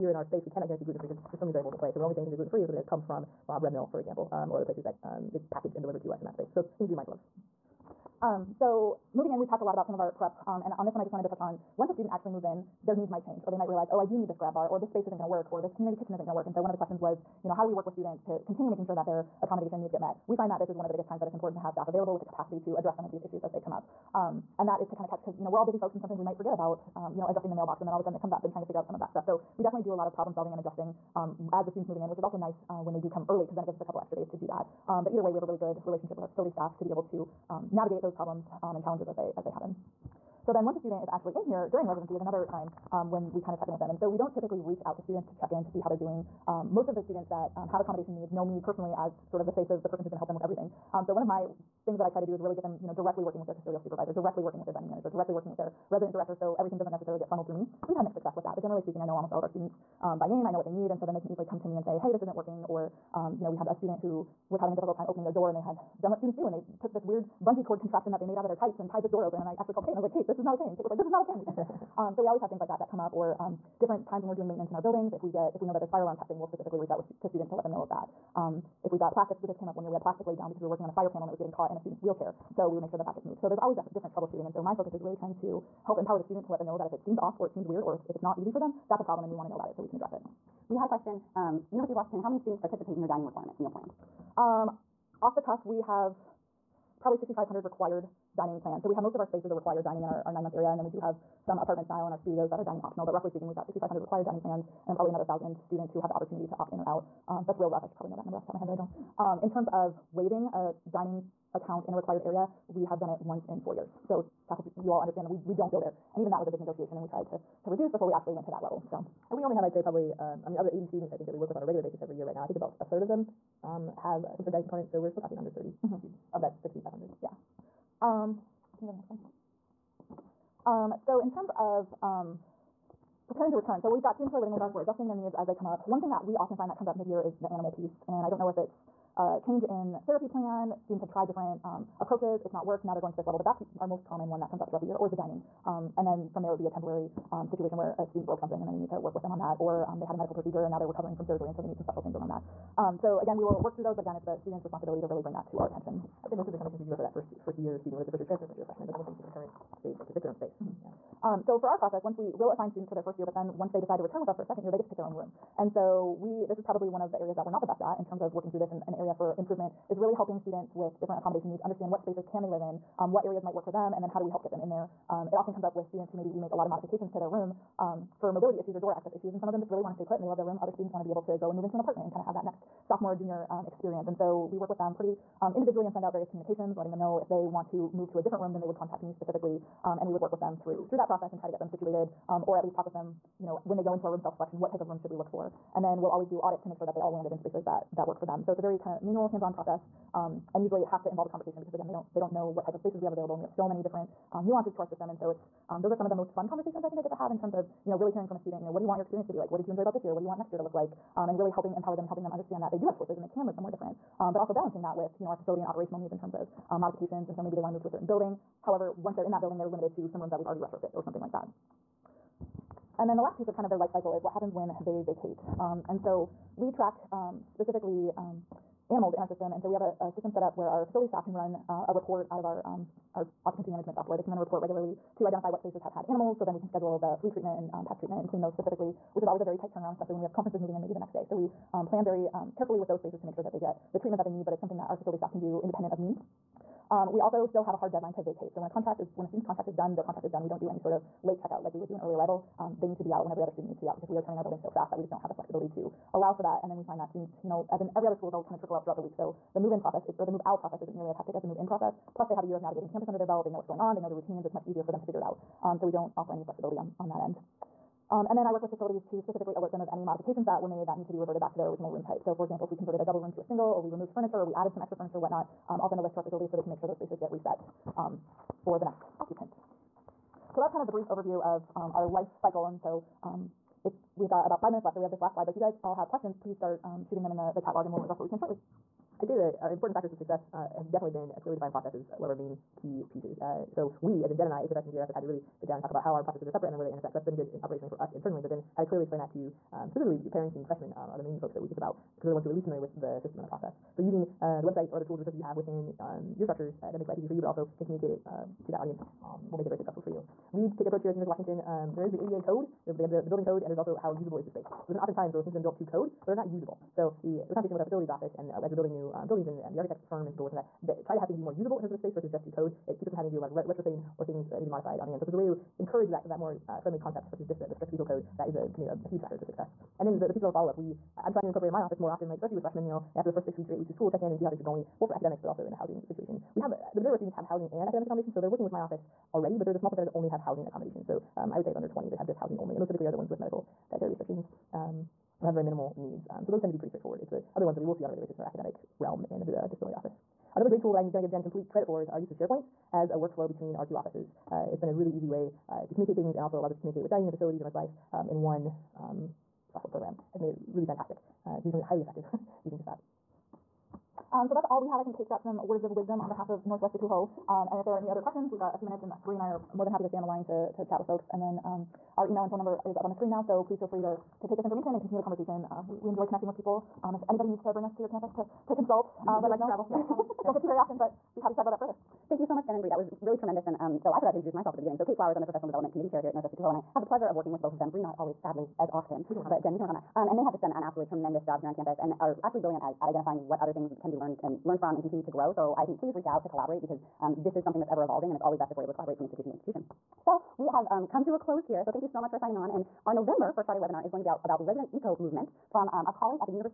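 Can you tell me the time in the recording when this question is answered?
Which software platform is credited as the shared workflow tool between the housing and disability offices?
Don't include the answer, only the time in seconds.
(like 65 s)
352 s.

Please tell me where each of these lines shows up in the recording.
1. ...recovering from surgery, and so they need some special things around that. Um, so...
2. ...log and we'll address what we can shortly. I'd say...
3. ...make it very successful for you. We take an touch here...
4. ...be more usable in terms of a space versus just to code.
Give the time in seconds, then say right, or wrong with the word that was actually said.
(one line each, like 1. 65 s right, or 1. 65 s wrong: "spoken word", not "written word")
1. 150 s right
2. 287 s right
3. 309 s wrong: "approach", not "touch"
4. 321 s right.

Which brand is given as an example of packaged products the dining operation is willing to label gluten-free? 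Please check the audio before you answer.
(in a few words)
Bob Red Mill.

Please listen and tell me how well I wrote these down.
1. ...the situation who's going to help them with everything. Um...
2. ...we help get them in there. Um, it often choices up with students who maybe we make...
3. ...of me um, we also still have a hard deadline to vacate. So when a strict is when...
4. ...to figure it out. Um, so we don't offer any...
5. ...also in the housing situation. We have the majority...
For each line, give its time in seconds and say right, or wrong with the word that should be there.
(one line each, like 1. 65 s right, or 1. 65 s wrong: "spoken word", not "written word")
1. 49 s wrong: "person", not "situation"
2. 174 s wrong: "comes", not "choices"
3. 245 s wrong: "contract", not "strict"
4. 264 s right
5. 335 s right.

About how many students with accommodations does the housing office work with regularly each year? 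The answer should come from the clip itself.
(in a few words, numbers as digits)
80.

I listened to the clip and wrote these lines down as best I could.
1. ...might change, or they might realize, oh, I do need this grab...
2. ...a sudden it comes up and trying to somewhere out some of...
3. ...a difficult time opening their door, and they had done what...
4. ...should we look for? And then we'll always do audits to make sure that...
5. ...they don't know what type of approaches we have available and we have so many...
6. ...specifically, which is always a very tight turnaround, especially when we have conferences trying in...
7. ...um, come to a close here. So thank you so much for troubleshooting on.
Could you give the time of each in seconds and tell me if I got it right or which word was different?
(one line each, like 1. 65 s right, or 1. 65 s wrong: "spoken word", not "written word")
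1. 13 s right
2. 28 s wrong: "figure", not "somewhere"
3. 64 s right
4. 195 s right
5. 202 s wrong: "spaces", not "approaches"
6. 238 s wrong: "moving", not "trying"
7. 400 s wrong: "signing", not "troubleshooting".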